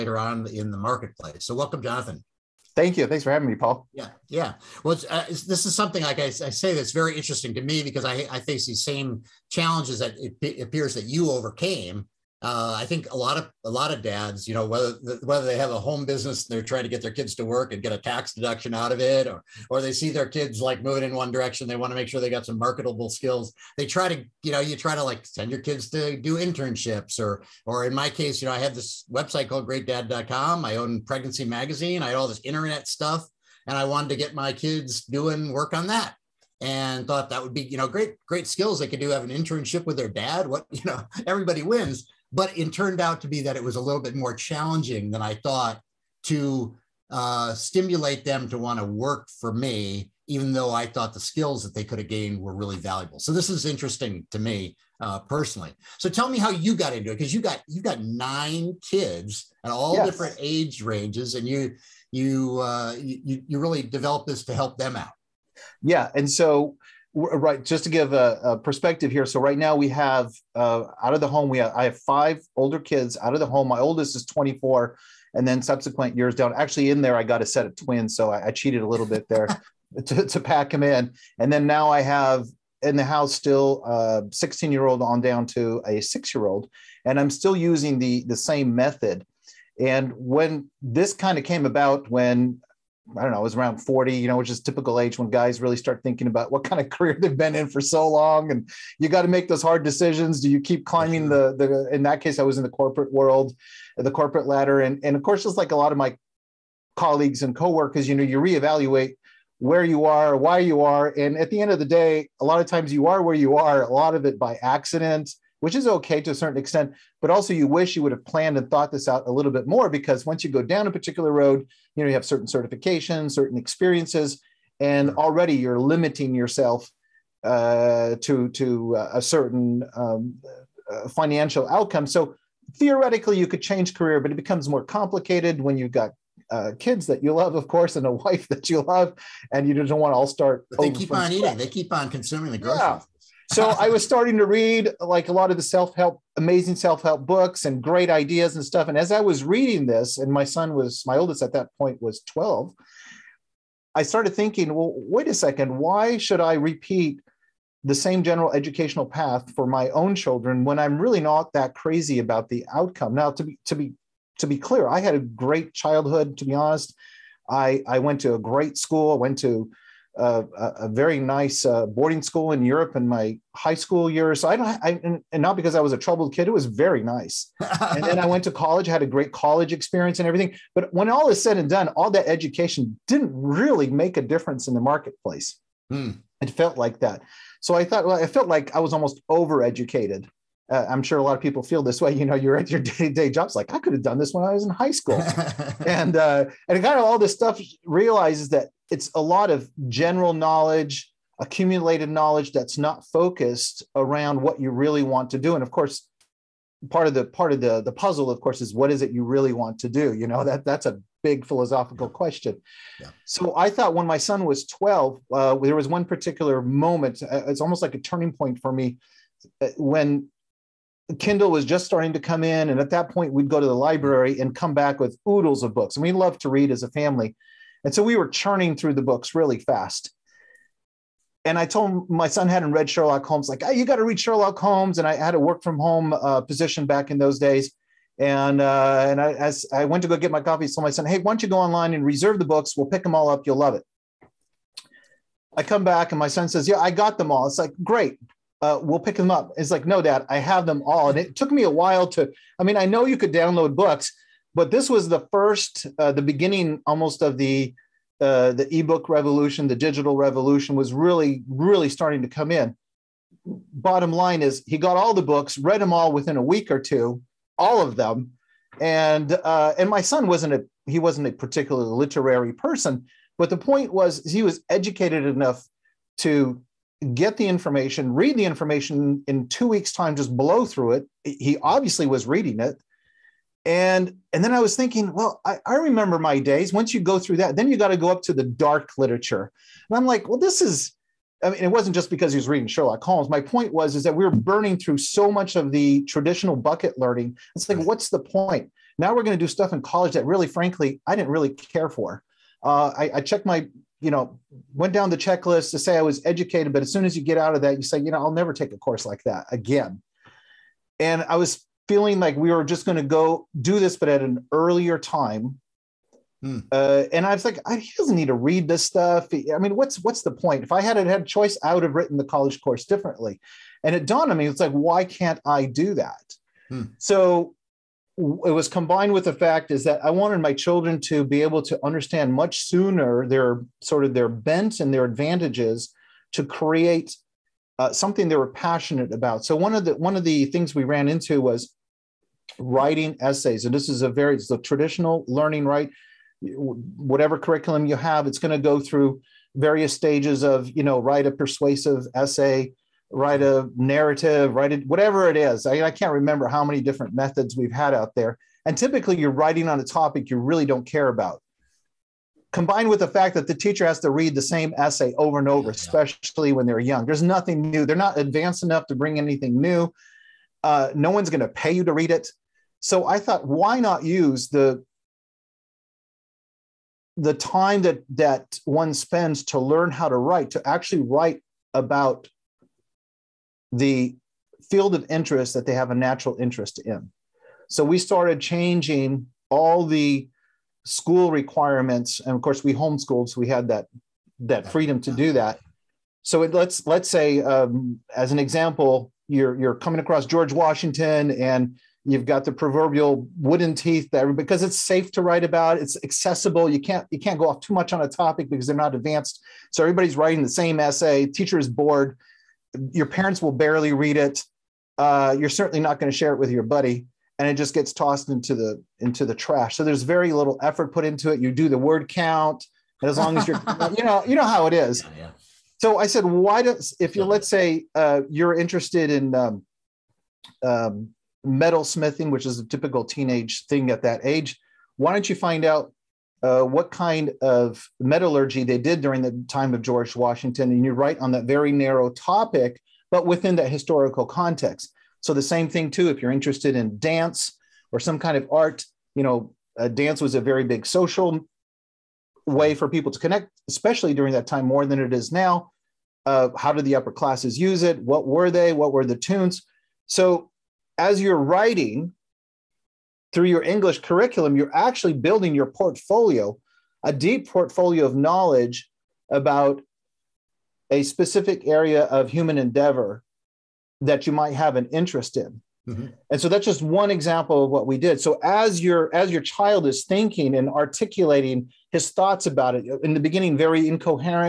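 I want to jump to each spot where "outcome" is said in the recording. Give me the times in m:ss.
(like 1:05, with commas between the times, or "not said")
2:11, 2:42.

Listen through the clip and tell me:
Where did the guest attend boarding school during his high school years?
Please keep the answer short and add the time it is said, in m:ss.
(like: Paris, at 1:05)
Europe, at 2:52.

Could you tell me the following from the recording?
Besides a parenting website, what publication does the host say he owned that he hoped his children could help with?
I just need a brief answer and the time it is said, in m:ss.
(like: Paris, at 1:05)
Pregnancy Magazine, at 0:31.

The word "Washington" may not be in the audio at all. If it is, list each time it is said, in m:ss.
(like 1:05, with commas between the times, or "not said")
6:40, 7:20.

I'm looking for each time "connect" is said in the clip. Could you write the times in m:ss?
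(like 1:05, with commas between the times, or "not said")
7:33.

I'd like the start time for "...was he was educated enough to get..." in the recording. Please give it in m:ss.
4:33.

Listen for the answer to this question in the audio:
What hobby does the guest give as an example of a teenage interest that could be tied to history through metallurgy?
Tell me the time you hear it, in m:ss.
7:11.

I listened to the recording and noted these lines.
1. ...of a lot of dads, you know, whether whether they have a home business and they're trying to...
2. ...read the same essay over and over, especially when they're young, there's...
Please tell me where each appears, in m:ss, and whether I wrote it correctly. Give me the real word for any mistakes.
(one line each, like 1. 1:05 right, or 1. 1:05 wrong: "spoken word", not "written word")
1. 0:13 right
2. 6:04 right.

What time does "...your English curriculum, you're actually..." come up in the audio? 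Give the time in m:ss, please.
7:43.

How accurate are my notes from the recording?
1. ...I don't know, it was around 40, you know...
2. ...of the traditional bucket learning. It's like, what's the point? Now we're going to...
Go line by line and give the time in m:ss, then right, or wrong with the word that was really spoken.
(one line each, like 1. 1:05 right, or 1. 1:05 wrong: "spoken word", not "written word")
1. 1:33 right
2. 4:55 right.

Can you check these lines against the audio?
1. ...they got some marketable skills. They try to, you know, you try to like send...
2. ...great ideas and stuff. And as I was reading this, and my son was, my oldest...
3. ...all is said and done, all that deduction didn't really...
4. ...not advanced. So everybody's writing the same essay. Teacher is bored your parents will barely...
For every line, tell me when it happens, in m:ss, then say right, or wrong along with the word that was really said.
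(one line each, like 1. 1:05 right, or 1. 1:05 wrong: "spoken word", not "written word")
1. 0:22 right
2. 2:27 right
3. 3:01 wrong: "education", not "deduction"
4. 6:48 right.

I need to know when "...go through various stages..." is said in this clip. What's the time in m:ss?
5:48.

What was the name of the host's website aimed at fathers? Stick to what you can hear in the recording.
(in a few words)
GreatDad.com.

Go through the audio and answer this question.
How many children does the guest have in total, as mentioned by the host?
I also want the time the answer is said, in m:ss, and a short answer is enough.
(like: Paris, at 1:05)
9, at 0:58.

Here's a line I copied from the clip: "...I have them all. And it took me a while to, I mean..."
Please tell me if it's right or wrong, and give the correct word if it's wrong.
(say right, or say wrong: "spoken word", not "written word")
right.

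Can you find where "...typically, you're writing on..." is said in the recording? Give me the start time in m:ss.
5:58.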